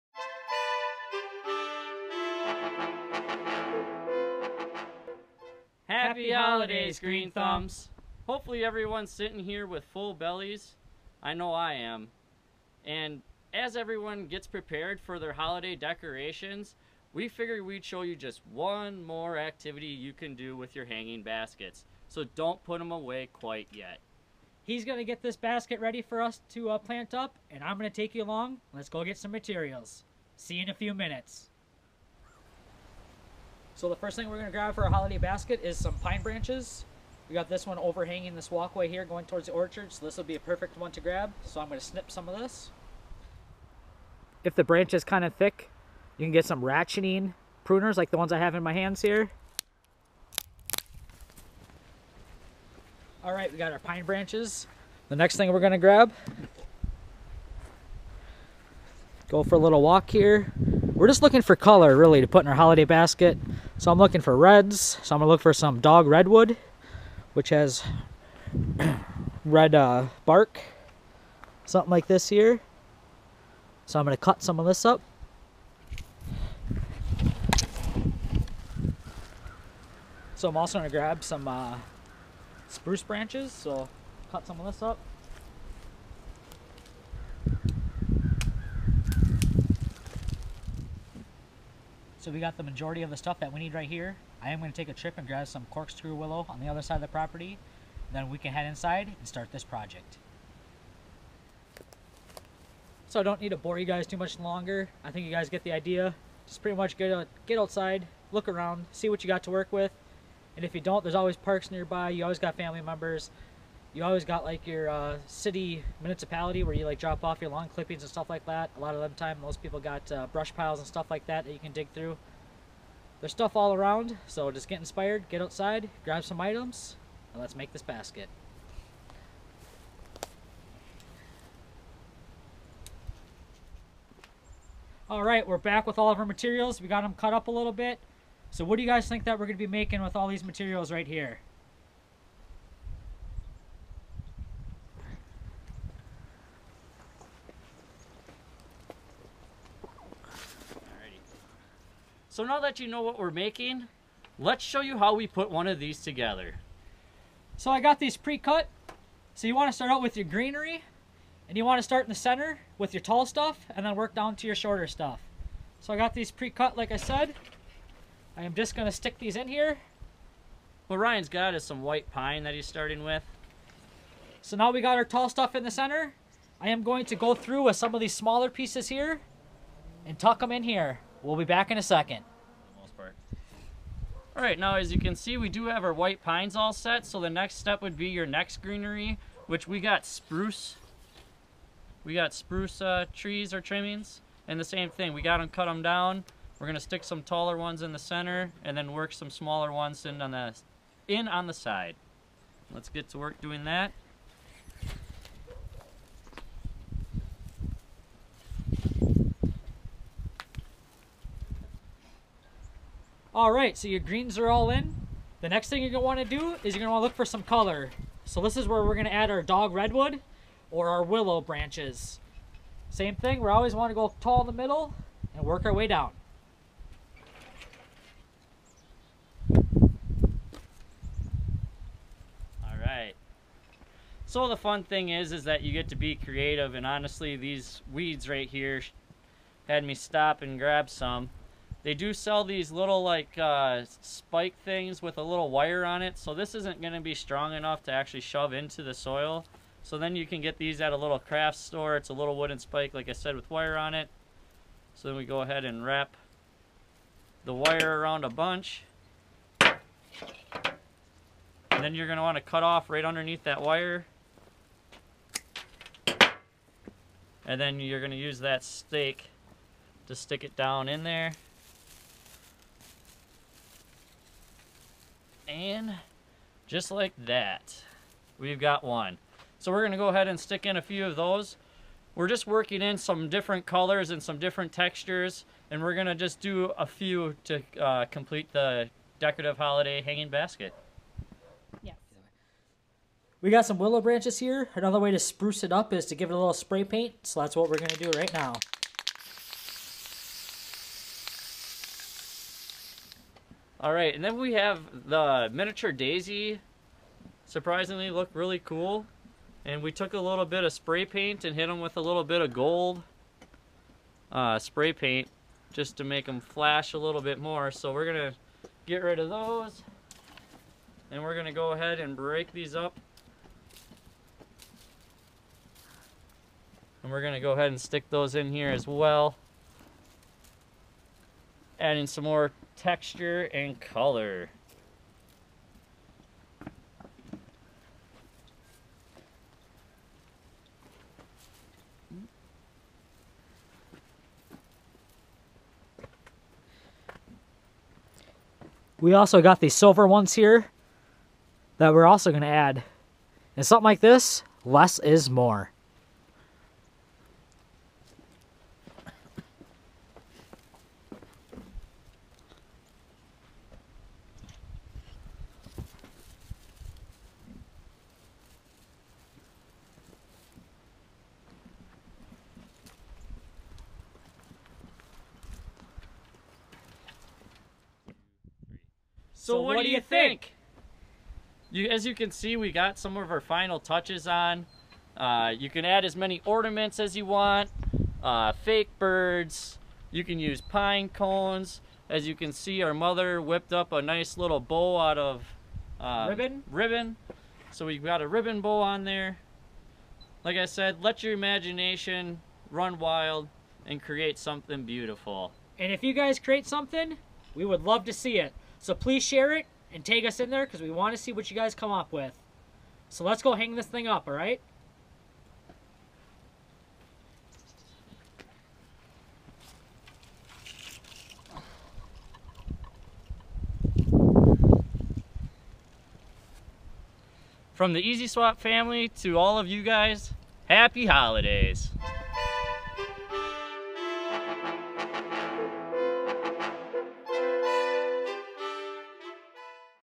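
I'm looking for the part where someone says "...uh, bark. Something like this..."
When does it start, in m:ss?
1:09.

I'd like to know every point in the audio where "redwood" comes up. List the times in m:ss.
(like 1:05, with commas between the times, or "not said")
1:06, 3:39.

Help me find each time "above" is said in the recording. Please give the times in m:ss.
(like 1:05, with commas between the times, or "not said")
not said.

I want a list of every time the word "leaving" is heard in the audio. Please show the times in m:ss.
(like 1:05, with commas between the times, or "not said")
not said.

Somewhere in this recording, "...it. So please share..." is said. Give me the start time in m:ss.
6:48.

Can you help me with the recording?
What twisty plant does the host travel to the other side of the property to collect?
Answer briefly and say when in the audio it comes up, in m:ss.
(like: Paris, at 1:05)
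Corkscrew willow, at 1:35.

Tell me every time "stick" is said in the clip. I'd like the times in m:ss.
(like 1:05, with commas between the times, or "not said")
2:48, 3:16, 4:30, 4:40, 5:27.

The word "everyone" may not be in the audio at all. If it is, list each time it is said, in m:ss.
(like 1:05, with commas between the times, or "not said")
0:08, 0:13.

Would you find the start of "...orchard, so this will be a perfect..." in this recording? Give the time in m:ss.
0:39.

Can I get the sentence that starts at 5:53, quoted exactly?
And something like this, less is more.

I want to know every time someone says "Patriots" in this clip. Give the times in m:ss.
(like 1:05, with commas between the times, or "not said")
not said.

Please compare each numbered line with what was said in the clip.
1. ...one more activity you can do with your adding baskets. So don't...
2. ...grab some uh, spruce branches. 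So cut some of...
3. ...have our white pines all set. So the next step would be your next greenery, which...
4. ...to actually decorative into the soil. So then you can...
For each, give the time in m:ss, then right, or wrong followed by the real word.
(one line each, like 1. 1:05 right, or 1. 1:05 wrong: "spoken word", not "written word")
1. 0:18 wrong: "hanging", not "adding"
2. 1:20 right
3. 3:05 right
4. 4:07 wrong: "shove", not "decorative".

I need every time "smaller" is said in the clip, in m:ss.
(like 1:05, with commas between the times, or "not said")
2:58, 3:19.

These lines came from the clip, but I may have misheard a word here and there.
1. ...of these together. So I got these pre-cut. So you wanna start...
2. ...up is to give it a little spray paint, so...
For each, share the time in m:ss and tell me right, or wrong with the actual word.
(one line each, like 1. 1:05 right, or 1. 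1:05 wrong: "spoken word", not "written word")
1. 2:35 right
2. 4:55 right.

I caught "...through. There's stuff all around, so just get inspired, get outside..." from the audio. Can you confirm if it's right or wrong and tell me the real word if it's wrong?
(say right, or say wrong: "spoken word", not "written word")
right.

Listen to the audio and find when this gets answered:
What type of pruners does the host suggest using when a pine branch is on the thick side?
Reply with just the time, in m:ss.
0:46.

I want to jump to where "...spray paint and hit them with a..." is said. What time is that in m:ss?
5:10.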